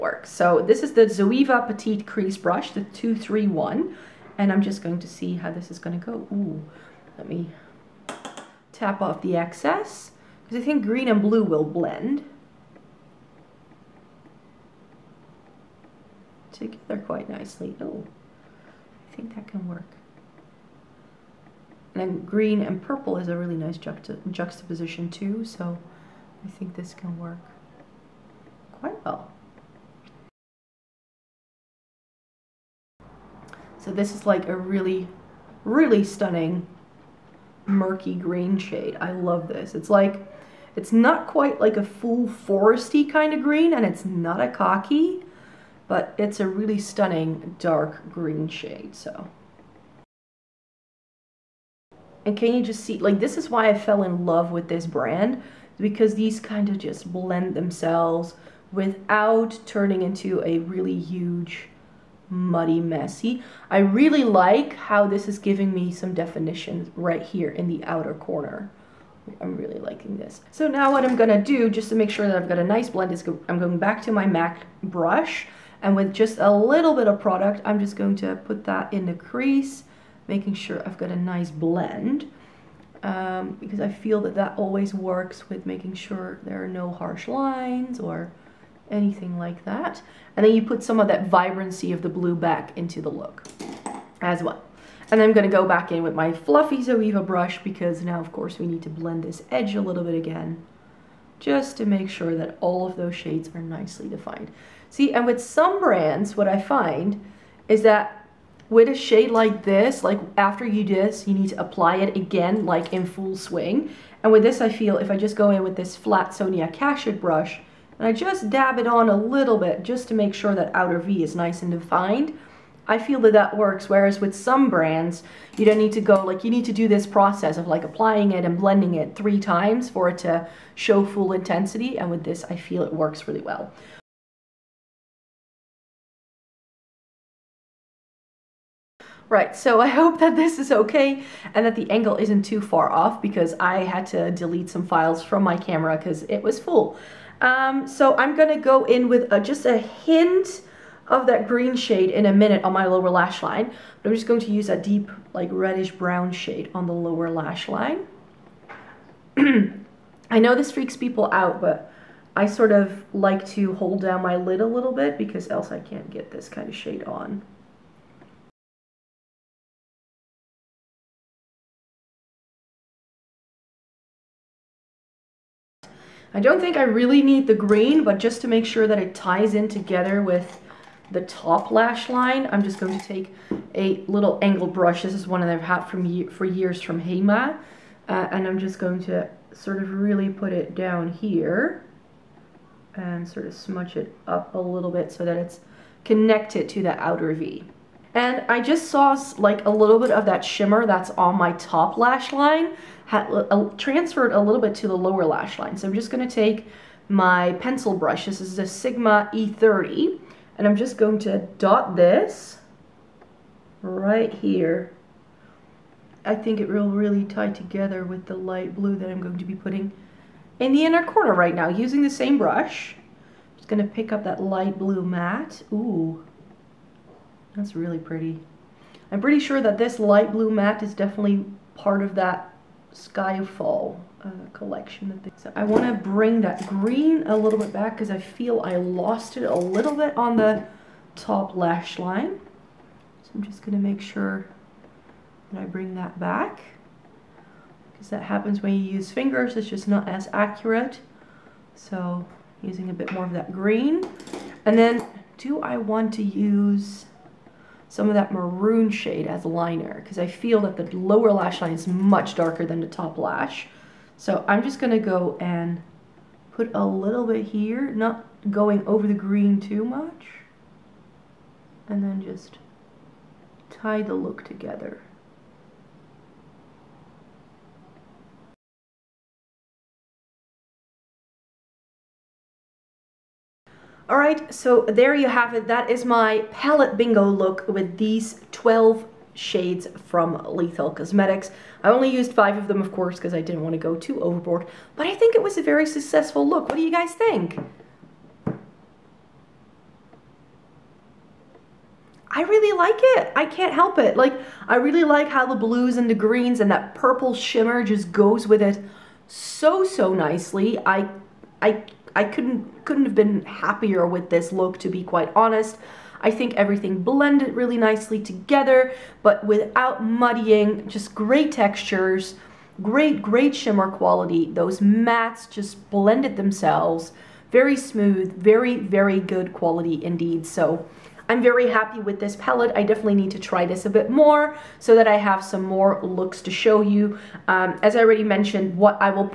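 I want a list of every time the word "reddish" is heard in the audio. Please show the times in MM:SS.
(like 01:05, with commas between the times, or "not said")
02:35.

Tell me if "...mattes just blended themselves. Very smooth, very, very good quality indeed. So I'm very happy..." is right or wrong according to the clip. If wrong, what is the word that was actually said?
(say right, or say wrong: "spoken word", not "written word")
right.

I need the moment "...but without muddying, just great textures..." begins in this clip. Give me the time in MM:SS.
05:19.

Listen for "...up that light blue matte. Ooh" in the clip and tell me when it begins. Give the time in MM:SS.
03:44.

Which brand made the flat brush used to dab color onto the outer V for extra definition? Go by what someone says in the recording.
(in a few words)
Sonia Kashuk.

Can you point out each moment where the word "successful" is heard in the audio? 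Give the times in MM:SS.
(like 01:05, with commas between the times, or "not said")
04:55.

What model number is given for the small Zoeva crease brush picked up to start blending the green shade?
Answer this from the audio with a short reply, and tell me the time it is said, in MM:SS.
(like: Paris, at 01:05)
231, at 00:02.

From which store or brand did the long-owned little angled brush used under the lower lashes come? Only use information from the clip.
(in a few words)
Hema.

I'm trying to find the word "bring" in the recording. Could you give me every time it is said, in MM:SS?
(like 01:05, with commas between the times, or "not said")
03:55, 04:05.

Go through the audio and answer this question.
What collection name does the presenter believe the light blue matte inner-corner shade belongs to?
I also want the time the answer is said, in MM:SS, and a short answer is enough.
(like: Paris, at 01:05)
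Skyfall, at 03:52.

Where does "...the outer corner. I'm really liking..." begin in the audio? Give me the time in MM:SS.
01:07.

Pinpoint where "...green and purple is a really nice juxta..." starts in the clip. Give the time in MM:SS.
00:22.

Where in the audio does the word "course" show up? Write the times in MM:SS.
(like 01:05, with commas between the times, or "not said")
01:38, 04:52.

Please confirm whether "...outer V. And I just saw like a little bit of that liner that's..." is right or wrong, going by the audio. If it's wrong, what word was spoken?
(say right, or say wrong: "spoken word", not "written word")
wrong: "shimmer", not "liner".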